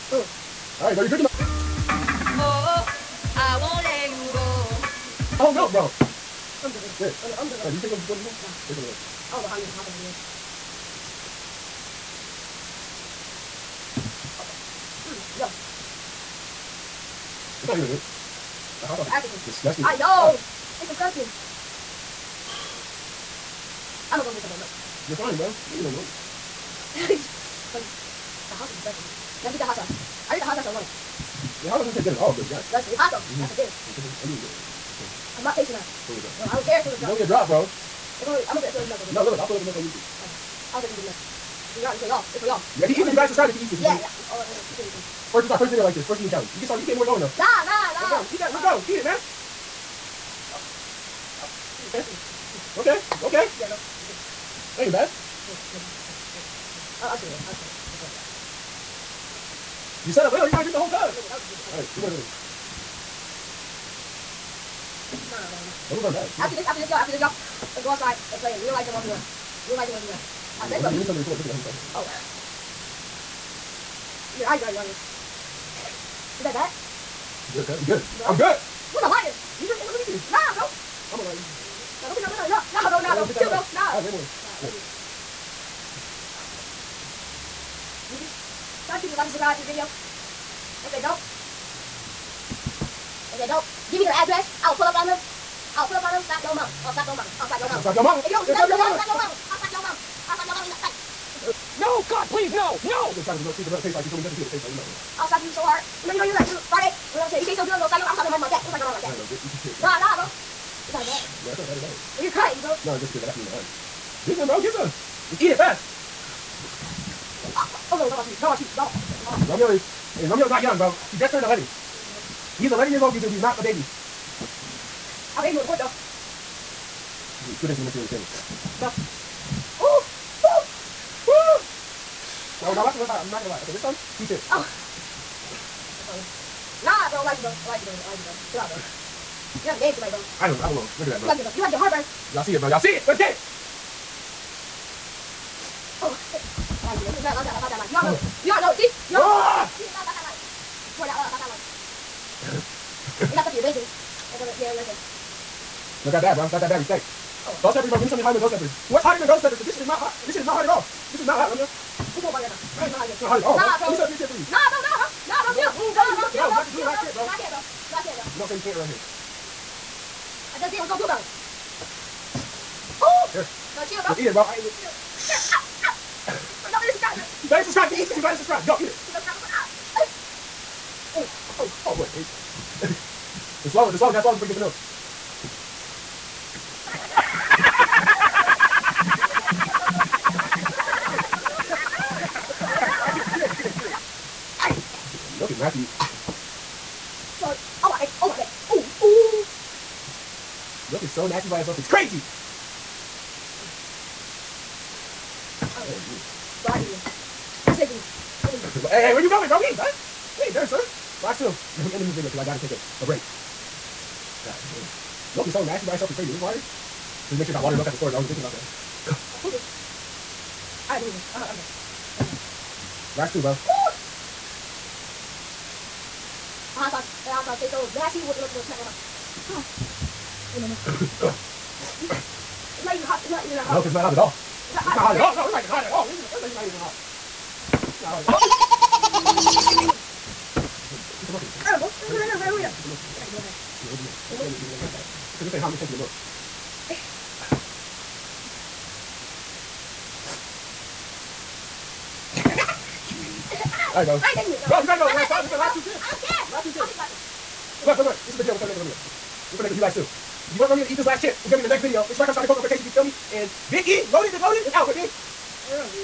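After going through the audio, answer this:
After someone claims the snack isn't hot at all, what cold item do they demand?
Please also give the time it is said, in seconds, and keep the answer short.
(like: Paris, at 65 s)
Cold butter, at 162 s.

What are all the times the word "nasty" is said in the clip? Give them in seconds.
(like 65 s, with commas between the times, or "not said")
195 s, 201 s, 215 s, 227 s.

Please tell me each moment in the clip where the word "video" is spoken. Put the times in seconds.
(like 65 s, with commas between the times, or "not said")
45 s, 89 s, 207 s, 212 s, 261 s.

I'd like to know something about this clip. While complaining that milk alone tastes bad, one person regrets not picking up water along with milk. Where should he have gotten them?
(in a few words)
The store.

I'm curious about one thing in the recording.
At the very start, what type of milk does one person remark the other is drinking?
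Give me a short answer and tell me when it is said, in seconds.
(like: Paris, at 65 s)
Whole milk, at 5 s.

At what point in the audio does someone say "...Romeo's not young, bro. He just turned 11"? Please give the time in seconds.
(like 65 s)
120 s.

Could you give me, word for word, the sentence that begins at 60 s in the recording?
You gotta drink the whole cup.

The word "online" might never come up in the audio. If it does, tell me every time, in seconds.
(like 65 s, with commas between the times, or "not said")
30 s.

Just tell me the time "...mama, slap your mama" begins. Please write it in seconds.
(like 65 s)
98 s.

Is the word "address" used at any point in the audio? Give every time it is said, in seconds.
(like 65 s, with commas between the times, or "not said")
94 s.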